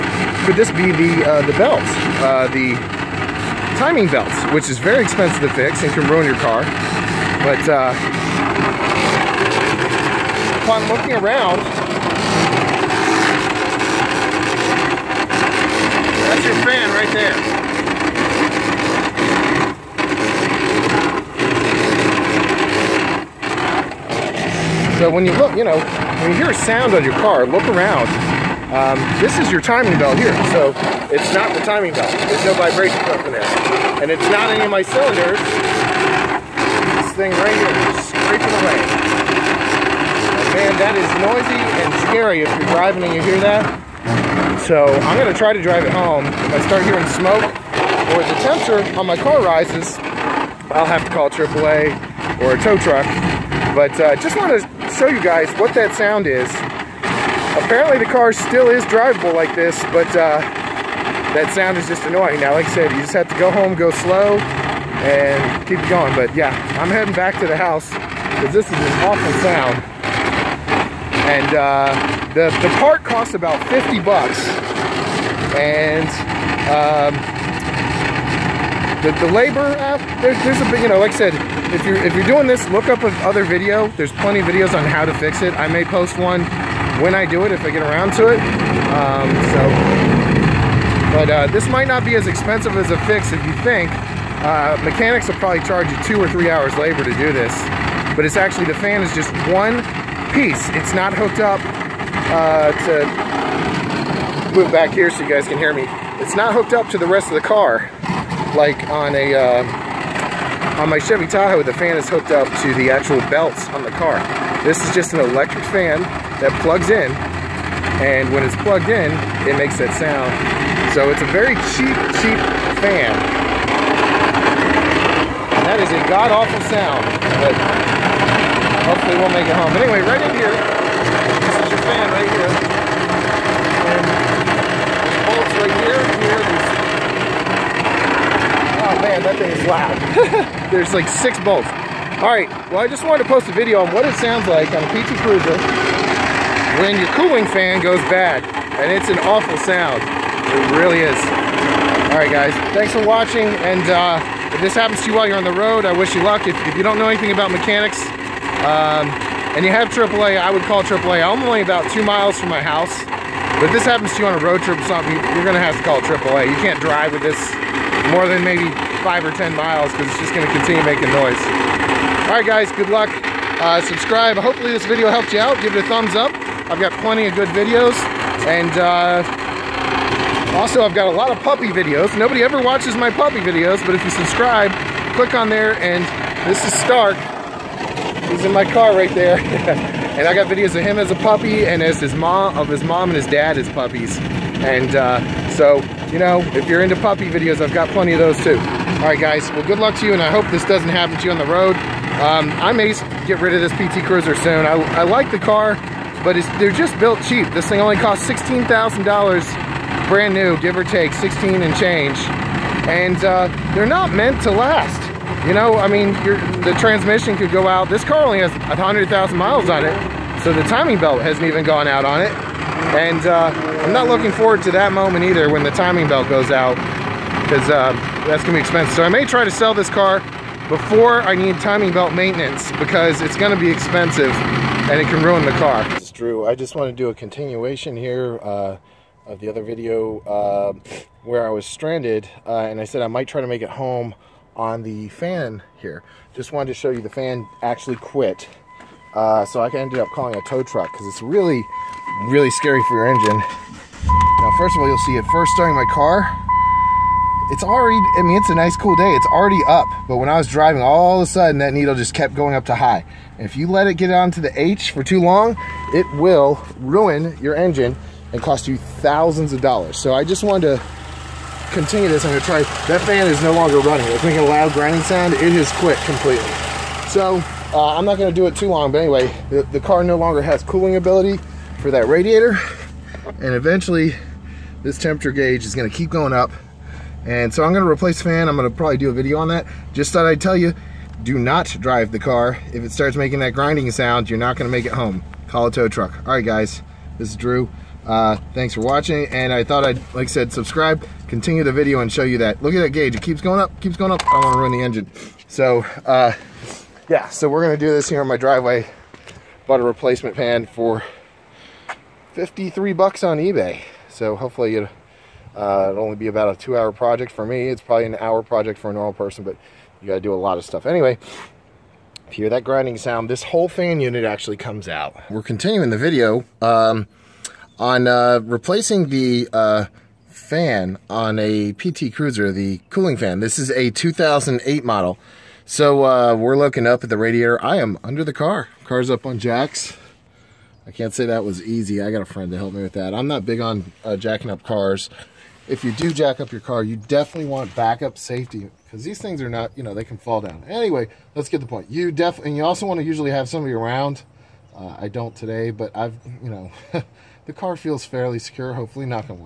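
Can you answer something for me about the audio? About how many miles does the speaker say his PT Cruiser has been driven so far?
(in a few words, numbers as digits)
100,000 miles.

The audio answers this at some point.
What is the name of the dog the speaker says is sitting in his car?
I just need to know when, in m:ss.
3:06.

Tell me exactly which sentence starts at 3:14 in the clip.
And uh, so, you know, if you're into puppy videos, I've got plenty of those too.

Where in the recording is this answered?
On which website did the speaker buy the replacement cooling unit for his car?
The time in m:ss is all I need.
5:13.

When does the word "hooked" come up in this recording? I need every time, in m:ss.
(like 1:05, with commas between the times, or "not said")
1:41, 1:46, 1:52.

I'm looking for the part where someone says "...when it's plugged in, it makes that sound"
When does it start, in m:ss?
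1:58.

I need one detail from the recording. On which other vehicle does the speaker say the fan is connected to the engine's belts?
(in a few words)
Chevy Tahoe.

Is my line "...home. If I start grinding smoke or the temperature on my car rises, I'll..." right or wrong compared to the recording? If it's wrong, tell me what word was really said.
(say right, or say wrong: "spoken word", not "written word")
wrong: "hearing", not "grinding".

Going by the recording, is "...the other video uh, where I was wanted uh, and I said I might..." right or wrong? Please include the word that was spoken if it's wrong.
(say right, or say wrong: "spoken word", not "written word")
wrong: "stranded", not "wanted".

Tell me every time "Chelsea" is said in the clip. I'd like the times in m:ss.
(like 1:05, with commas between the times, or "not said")
not said.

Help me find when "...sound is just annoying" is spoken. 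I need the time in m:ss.
1:01.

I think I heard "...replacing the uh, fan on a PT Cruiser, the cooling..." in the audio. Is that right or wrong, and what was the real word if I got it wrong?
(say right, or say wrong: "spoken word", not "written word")
right.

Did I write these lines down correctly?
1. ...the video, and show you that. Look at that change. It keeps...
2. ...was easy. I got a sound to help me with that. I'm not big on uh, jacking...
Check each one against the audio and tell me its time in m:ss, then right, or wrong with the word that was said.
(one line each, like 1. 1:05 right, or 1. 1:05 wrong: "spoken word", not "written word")
1. 5:01 wrong: "gauge", not "change"
2. 5:41 wrong: "friend", not "sound".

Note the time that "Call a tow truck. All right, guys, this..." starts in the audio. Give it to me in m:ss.
4:55.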